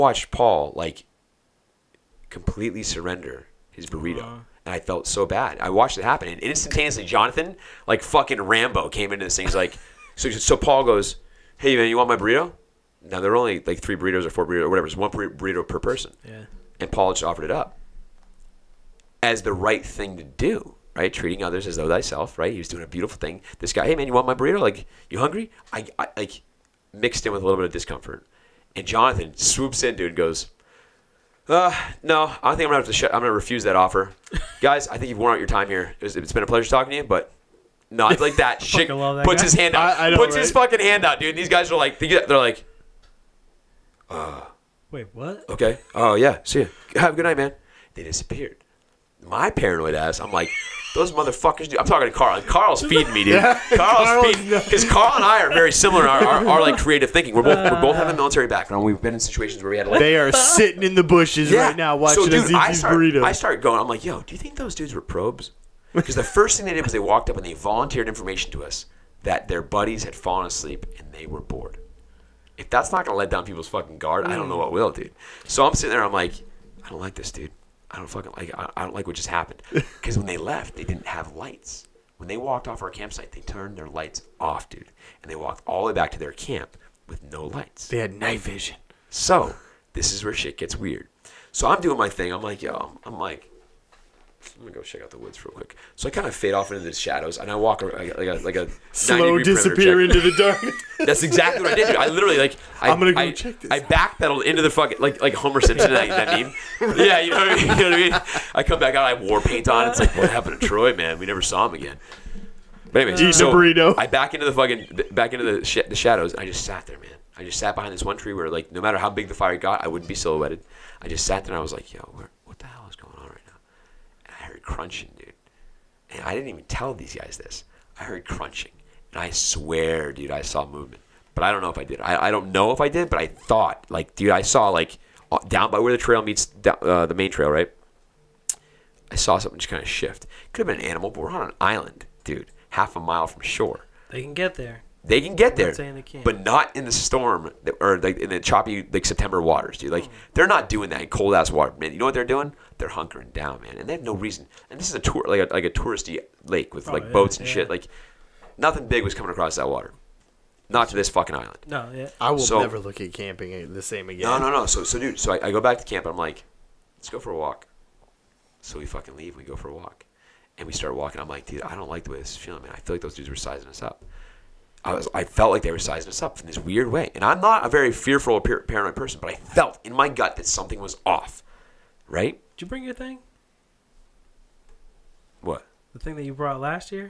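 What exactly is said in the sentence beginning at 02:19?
I saw something just kind of shift.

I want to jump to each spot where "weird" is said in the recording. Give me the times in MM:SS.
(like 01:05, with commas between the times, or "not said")
01:30, 02:56.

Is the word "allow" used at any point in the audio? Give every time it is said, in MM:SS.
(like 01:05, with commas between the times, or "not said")
not said.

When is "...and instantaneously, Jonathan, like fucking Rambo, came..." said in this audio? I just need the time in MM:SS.
00:06.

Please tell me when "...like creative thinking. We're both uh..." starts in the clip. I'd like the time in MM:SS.
00:56.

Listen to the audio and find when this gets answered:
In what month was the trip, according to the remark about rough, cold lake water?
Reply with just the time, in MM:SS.
02:29.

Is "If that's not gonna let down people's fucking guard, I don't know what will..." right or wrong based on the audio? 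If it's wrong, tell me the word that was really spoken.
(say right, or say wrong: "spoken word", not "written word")
right.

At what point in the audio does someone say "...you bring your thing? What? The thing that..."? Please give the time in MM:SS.
03:02.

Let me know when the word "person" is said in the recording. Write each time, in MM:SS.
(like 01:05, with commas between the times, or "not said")
00:15, 02:58.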